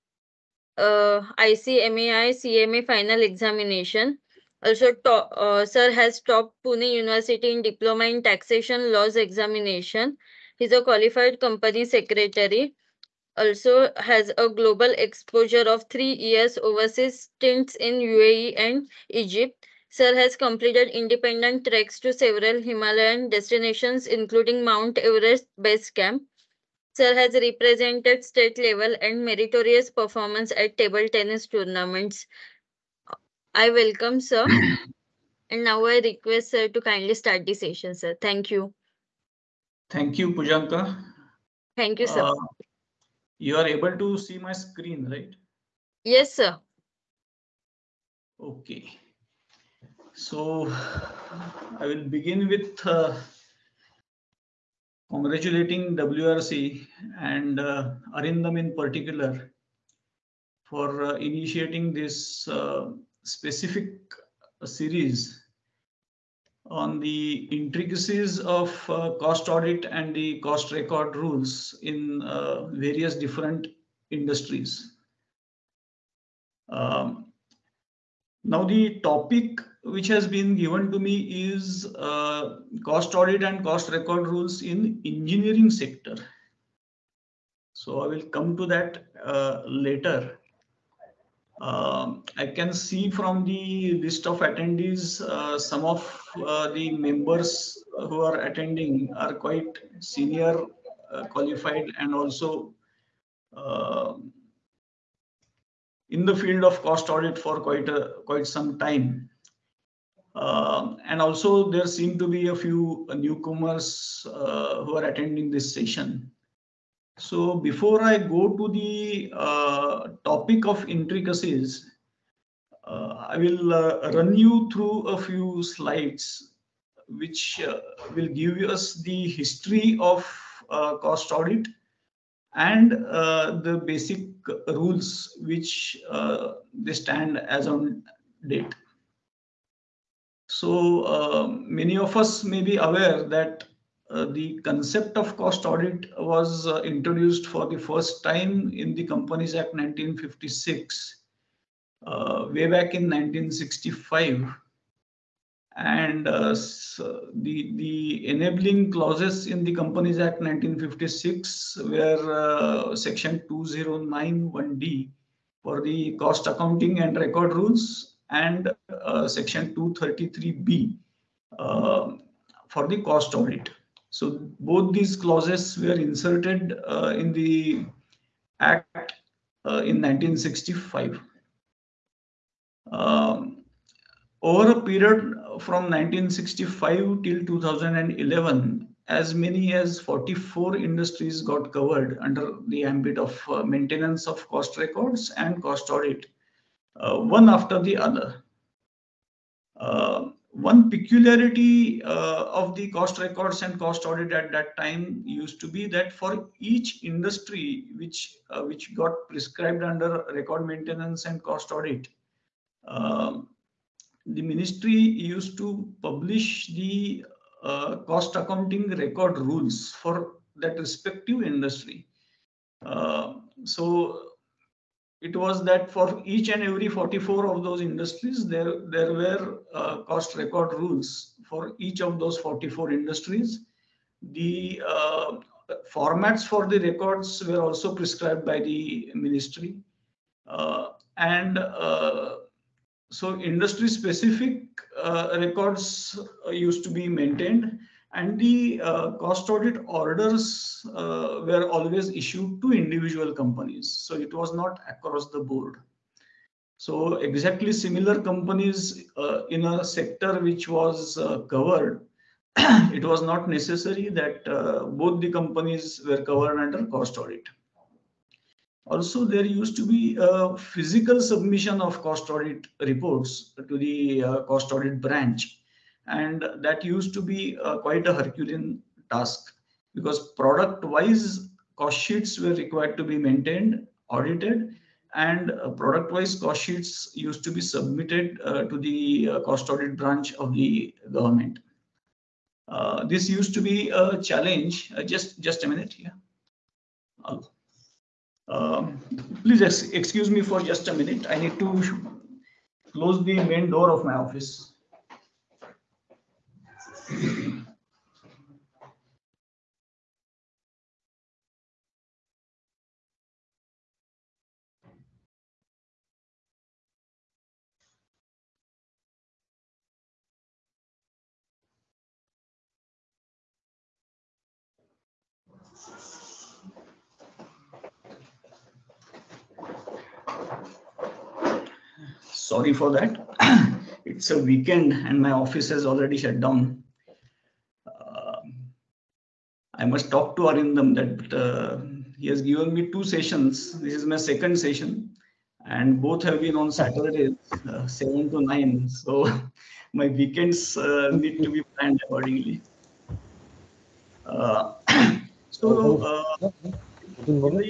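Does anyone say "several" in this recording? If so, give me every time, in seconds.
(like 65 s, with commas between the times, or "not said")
22 s.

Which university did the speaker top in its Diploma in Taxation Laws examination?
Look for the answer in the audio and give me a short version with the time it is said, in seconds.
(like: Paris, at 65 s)
Pune University, at 6 s.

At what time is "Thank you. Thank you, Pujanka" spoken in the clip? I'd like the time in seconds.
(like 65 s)
38 s.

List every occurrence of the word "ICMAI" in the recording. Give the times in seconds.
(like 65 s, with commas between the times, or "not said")
1 s.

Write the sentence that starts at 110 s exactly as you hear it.
Um, and also, there seem to be a few newcomers uh, who are attending this session.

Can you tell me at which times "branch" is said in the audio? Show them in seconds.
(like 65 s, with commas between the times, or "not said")
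274 s, 289 s.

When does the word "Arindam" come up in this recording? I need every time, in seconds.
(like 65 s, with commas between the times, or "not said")
58 s, 340 s.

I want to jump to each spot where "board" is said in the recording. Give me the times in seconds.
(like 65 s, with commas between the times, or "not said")
255 s.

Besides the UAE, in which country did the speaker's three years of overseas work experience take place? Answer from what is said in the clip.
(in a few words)
Egypt.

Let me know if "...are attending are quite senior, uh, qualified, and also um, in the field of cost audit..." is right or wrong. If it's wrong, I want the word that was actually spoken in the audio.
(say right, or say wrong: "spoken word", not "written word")
right.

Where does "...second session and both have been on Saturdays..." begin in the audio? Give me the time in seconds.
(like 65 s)
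344 s.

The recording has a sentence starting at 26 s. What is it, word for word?
Sir has represented state level and meritorious performance at table tennis tournaments.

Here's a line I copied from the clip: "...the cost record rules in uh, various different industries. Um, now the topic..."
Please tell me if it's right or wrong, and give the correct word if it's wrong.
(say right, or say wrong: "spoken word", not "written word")
right.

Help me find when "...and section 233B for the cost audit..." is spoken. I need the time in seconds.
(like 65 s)
168 s.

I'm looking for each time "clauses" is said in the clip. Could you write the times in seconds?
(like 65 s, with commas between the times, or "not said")
158 s, 175 s.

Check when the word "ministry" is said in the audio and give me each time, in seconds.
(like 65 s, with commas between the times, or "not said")
214 s, 239 s.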